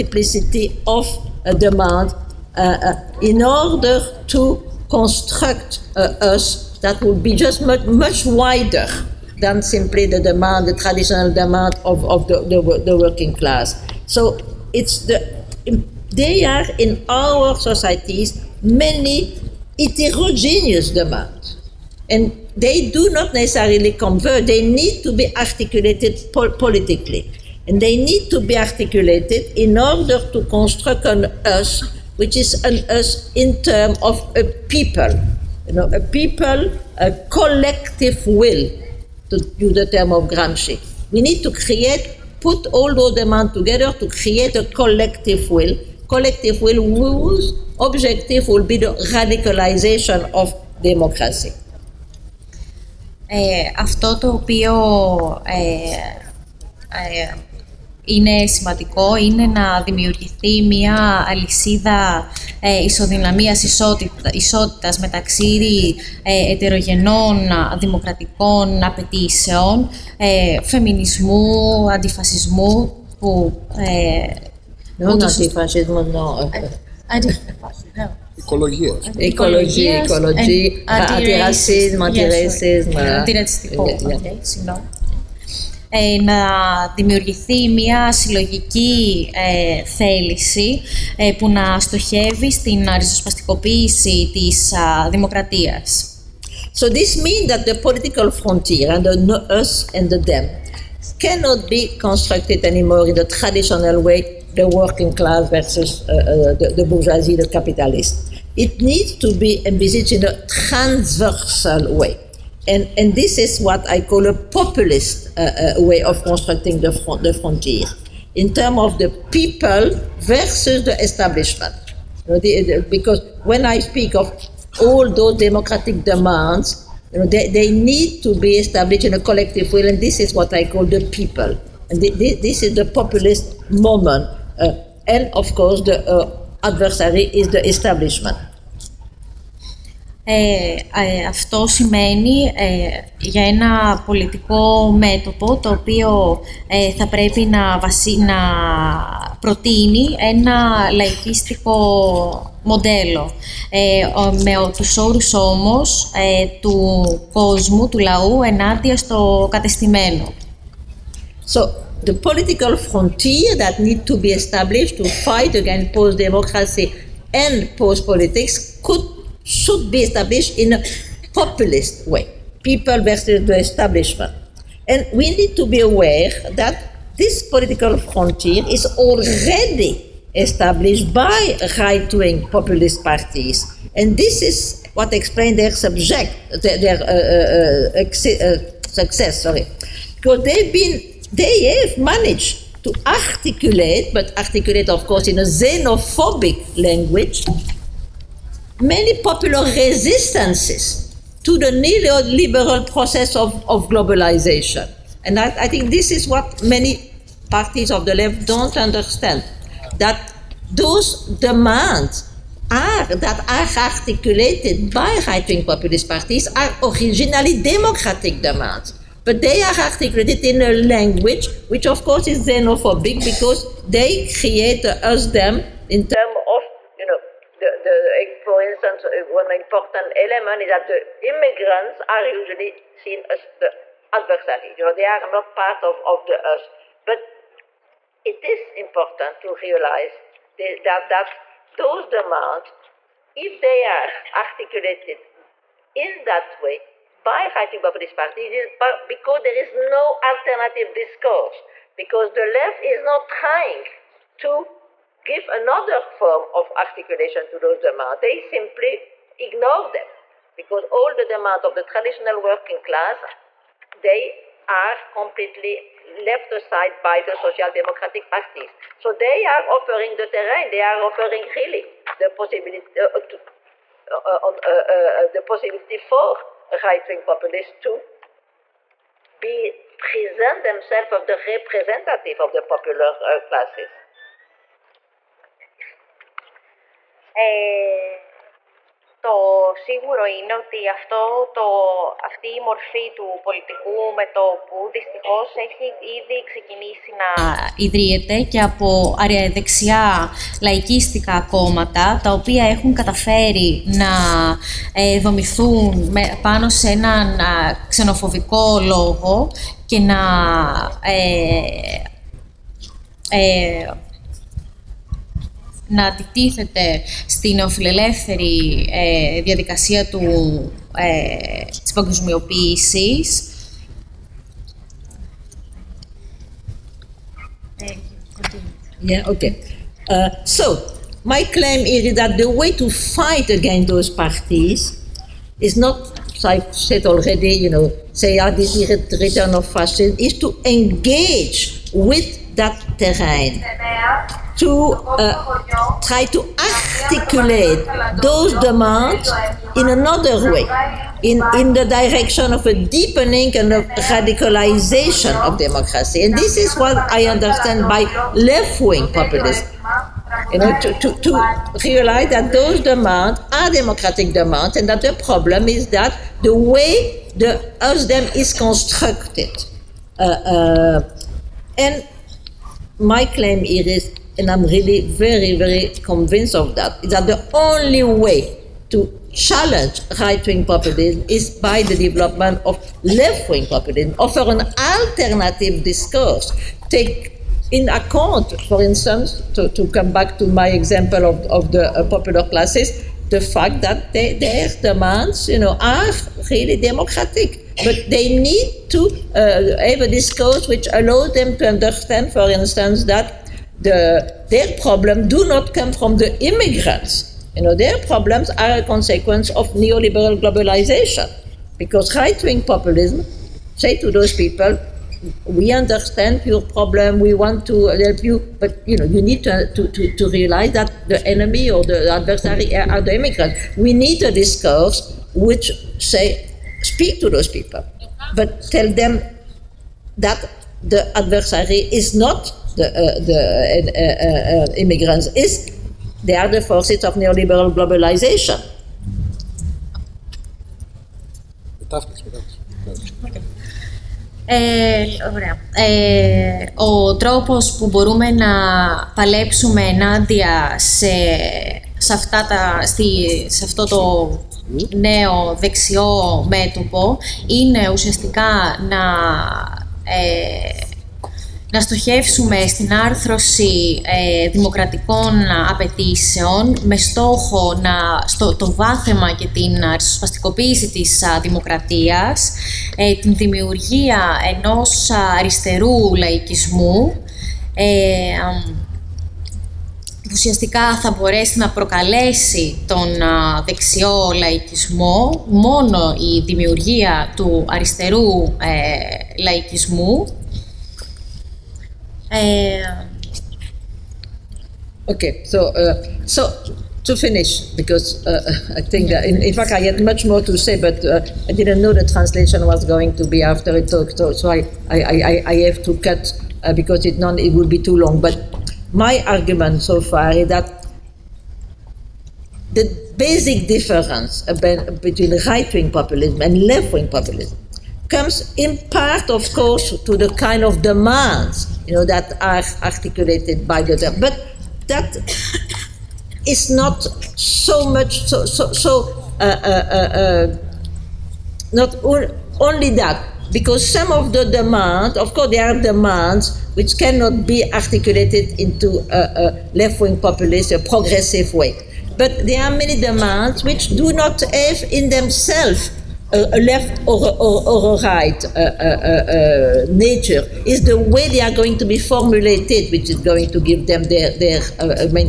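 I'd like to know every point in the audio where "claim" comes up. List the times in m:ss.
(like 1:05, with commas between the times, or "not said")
5:31, 6:13.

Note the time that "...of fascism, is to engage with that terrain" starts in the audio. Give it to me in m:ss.
5:39.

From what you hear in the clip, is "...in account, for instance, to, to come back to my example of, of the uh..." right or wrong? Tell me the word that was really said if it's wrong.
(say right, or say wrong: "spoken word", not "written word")
right.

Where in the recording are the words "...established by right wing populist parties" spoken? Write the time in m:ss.
3:00.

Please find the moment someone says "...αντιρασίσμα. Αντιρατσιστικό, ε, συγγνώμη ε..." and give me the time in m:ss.
1:22.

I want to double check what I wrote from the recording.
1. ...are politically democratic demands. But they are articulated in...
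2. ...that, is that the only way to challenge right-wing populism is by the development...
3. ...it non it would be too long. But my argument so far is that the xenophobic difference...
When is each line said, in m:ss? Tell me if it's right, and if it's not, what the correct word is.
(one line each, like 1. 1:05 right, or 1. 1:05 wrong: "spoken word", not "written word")
1. 3:36 wrong: "originally", not "politically"
2. 6:16 right
3. 8:27 wrong: "basic", not "xenophobic".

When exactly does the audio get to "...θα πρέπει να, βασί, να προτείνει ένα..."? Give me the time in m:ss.
2:26.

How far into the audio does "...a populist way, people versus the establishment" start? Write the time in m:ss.
2:50.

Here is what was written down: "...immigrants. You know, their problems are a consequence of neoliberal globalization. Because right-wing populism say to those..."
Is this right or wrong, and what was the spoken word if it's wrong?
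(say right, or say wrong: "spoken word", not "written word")
right.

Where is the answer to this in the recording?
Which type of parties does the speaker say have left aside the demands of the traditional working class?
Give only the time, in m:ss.
4:27.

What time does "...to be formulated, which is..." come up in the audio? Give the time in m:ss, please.
9:11.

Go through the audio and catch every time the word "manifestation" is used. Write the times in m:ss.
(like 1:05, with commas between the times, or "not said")
not said.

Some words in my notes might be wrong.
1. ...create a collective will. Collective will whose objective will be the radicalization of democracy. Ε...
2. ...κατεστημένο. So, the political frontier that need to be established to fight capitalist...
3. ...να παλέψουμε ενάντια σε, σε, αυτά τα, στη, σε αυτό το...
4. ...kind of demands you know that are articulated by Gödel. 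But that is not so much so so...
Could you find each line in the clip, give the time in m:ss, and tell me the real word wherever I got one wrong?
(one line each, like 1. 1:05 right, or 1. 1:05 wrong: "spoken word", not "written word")
1. 0:44 right
2. 2:39 wrong: "against", not "capitalist"
3. 7:28 right
4. 8:40 right.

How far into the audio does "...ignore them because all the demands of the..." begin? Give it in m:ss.
4:19.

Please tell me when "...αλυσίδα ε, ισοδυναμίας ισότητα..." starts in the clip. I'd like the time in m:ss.
1:01.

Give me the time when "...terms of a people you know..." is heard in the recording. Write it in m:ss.
0:33.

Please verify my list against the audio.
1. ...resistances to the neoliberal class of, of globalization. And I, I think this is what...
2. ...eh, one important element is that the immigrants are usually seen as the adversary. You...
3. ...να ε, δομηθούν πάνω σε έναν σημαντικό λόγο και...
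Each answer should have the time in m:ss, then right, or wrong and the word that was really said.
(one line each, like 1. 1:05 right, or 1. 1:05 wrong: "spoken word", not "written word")
1. 3:19 wrong: "process", not "class"
2. 3:49 right
3. 5:03 wrong: "ξενοφοβικό", not "σημαντικό".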